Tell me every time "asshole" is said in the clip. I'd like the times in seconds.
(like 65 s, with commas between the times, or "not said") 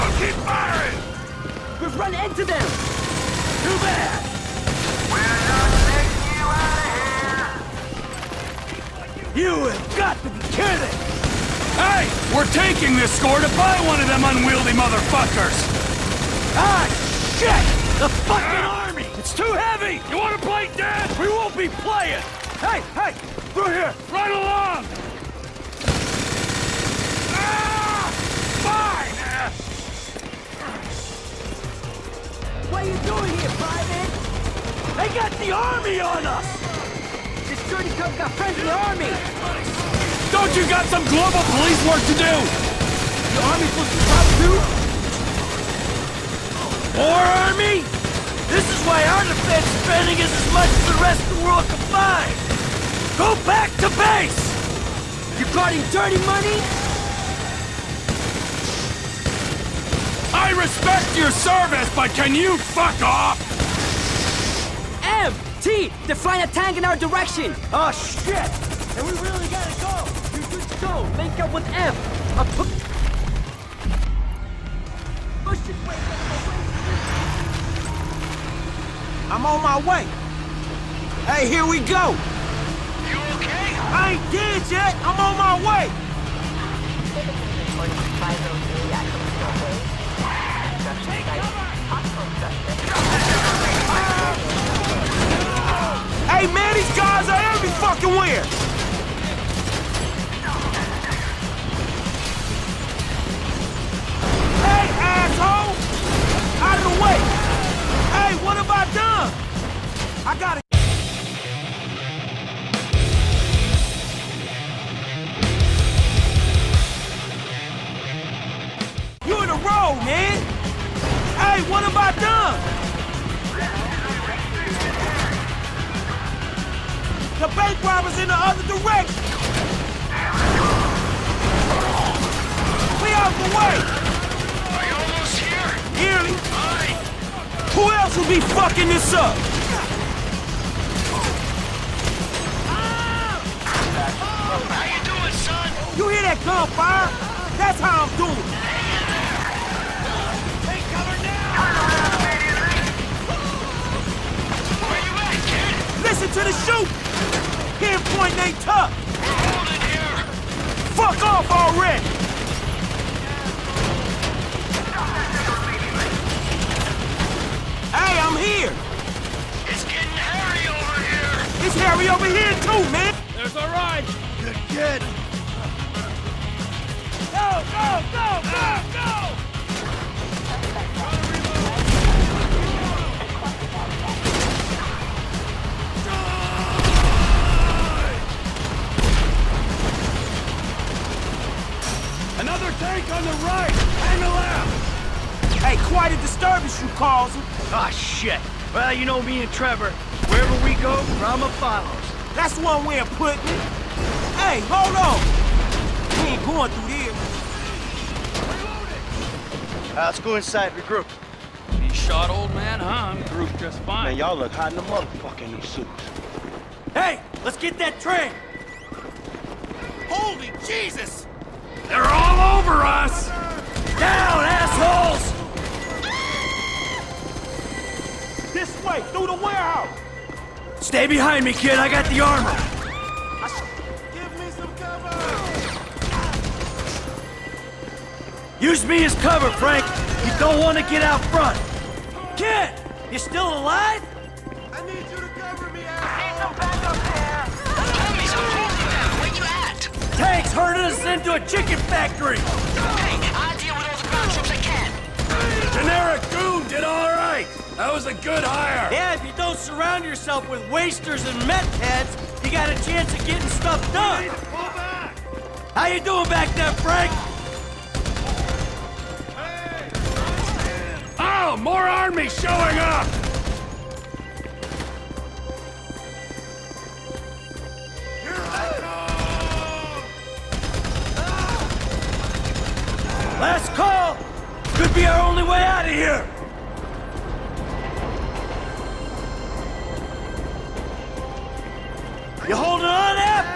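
105 s, 224 s, 245 s.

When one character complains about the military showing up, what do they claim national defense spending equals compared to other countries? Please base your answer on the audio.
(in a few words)
The rest of the world combined.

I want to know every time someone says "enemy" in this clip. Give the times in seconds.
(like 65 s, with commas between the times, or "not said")
248 s.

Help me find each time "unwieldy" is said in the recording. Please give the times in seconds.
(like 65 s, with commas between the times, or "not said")
14 s.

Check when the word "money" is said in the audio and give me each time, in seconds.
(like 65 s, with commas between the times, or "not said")
56 s.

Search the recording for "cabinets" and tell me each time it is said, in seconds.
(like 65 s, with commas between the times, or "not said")
not said.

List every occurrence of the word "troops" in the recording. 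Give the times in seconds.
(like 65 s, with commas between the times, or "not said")
254 s.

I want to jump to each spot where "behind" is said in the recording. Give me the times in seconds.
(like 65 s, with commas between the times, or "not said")
231 s.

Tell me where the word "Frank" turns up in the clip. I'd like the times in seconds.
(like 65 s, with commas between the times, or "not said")
239 s, 266 s.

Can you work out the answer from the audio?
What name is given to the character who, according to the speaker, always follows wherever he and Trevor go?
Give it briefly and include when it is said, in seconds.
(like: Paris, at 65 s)
Rama, at 201 s.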